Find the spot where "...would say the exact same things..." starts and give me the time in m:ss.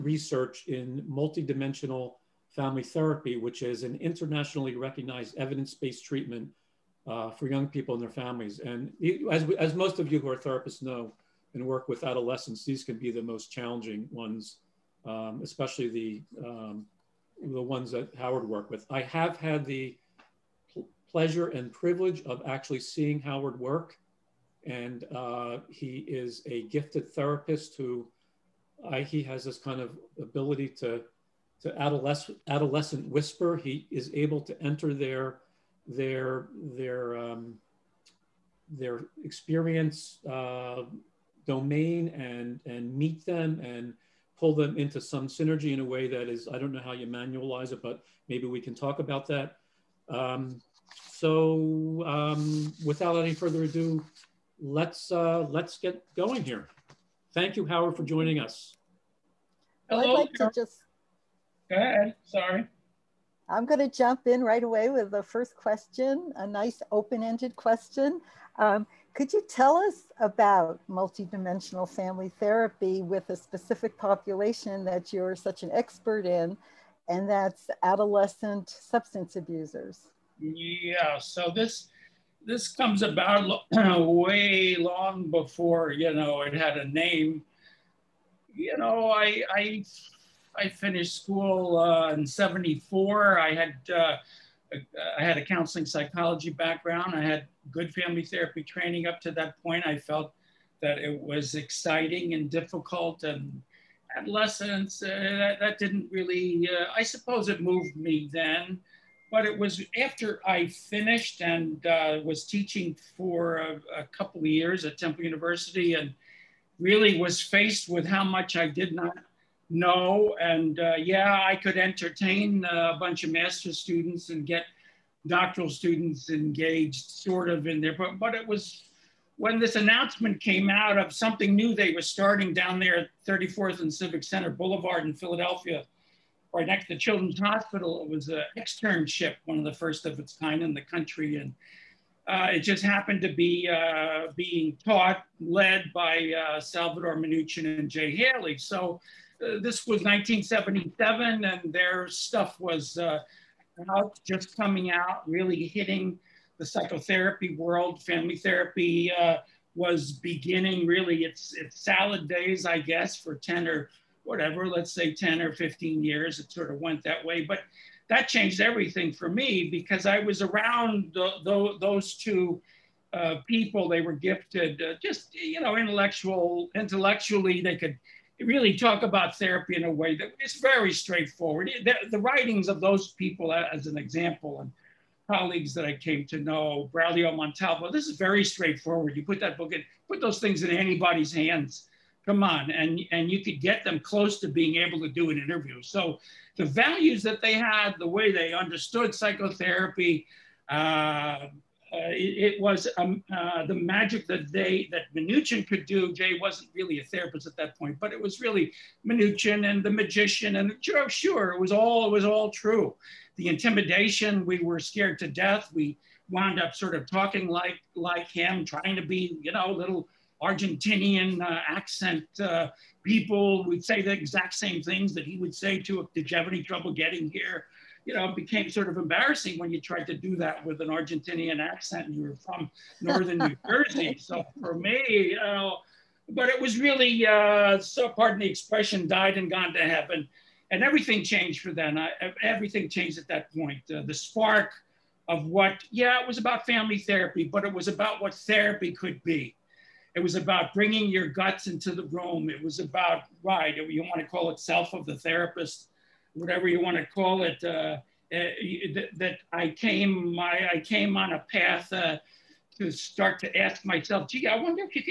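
3:43.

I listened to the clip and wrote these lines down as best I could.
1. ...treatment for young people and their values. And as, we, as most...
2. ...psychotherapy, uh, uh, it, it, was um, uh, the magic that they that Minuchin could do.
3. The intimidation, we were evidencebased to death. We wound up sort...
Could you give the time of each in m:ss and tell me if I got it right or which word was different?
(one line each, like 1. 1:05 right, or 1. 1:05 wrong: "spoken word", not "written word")
1. 0:06 wrong: "families", not "values"
2. 3:19 right
3. 3:33 wrong: "scared", not "evidencebased".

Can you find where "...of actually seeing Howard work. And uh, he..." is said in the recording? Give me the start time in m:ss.
0:22.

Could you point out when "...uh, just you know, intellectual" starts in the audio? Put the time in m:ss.
2:54.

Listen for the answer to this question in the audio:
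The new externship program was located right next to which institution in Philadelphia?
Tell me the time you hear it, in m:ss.
2:16.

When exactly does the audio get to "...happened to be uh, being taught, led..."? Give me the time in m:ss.
2:22.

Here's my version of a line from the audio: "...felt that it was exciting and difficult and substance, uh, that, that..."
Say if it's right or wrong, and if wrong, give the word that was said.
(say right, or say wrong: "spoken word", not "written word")
wrong: "adolescence", not "substance".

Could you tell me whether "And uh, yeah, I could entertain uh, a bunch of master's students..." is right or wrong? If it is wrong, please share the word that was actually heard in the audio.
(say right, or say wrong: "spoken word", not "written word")
right.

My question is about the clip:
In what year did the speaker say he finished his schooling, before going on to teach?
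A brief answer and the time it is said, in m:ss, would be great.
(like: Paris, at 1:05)
1974, at 1:32.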